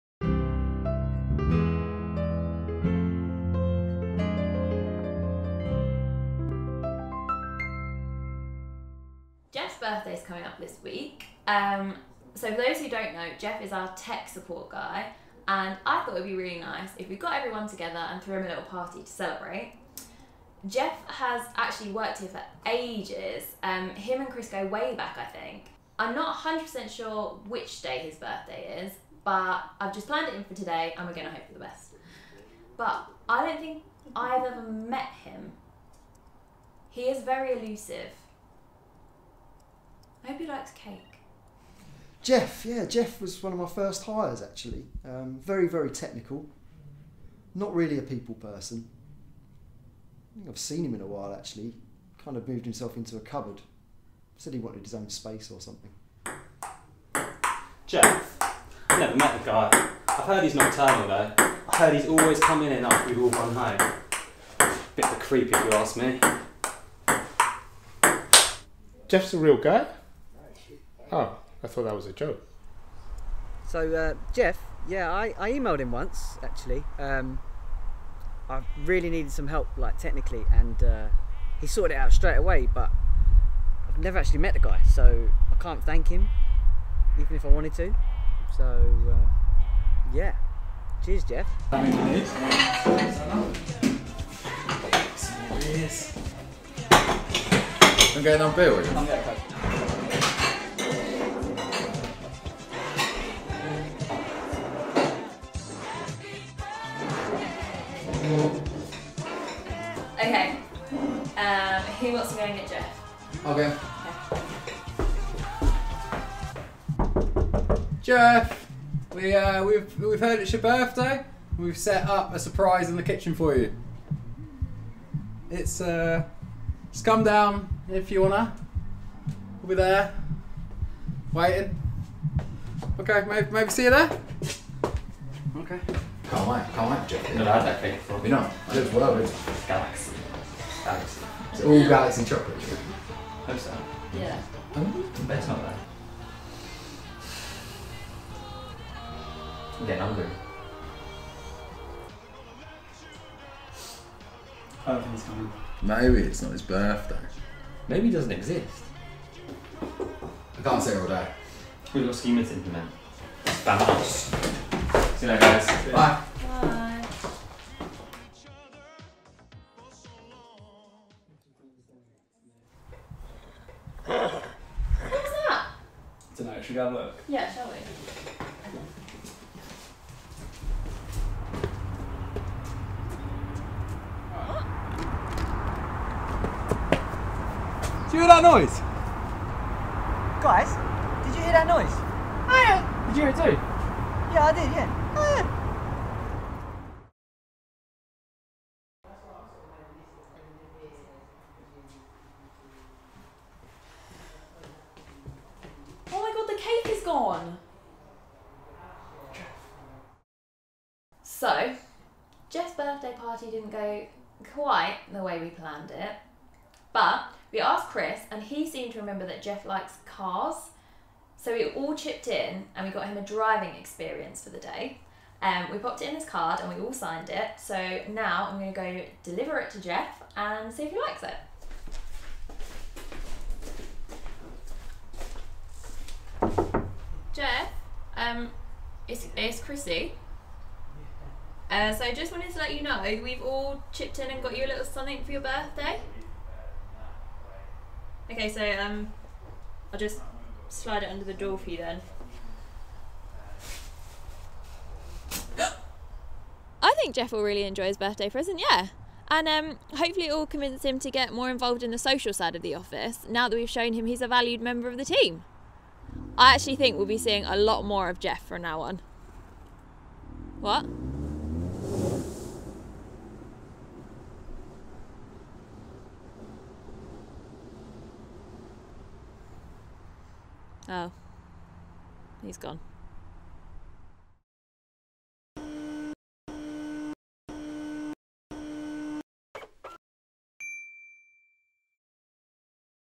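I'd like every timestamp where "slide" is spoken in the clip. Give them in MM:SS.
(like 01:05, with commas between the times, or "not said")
04:10.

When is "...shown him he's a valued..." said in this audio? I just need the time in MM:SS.
04:23.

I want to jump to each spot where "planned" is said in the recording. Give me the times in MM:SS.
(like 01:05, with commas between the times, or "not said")
00:30, 03:35.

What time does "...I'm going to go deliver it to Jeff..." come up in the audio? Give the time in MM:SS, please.
03:48.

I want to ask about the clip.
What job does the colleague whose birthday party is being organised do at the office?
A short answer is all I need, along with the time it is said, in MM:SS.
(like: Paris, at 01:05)
Tech support, at 00:13.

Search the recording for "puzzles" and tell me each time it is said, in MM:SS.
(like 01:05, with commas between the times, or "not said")
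not said.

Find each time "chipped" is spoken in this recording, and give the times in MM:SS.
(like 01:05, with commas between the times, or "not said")
03:41, 04:03.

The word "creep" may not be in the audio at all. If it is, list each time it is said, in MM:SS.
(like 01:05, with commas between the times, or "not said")
01:05.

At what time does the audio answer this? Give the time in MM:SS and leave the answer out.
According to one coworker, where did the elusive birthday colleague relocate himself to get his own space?
00:52.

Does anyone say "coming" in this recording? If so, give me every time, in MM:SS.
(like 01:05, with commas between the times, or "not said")
00:10, 01:02, 02:35.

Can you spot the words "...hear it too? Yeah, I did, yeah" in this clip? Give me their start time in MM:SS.
03:13.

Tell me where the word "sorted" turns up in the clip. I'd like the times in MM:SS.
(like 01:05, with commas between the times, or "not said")
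01:21.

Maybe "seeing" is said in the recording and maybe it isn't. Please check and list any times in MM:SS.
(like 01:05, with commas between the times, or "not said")
04:27.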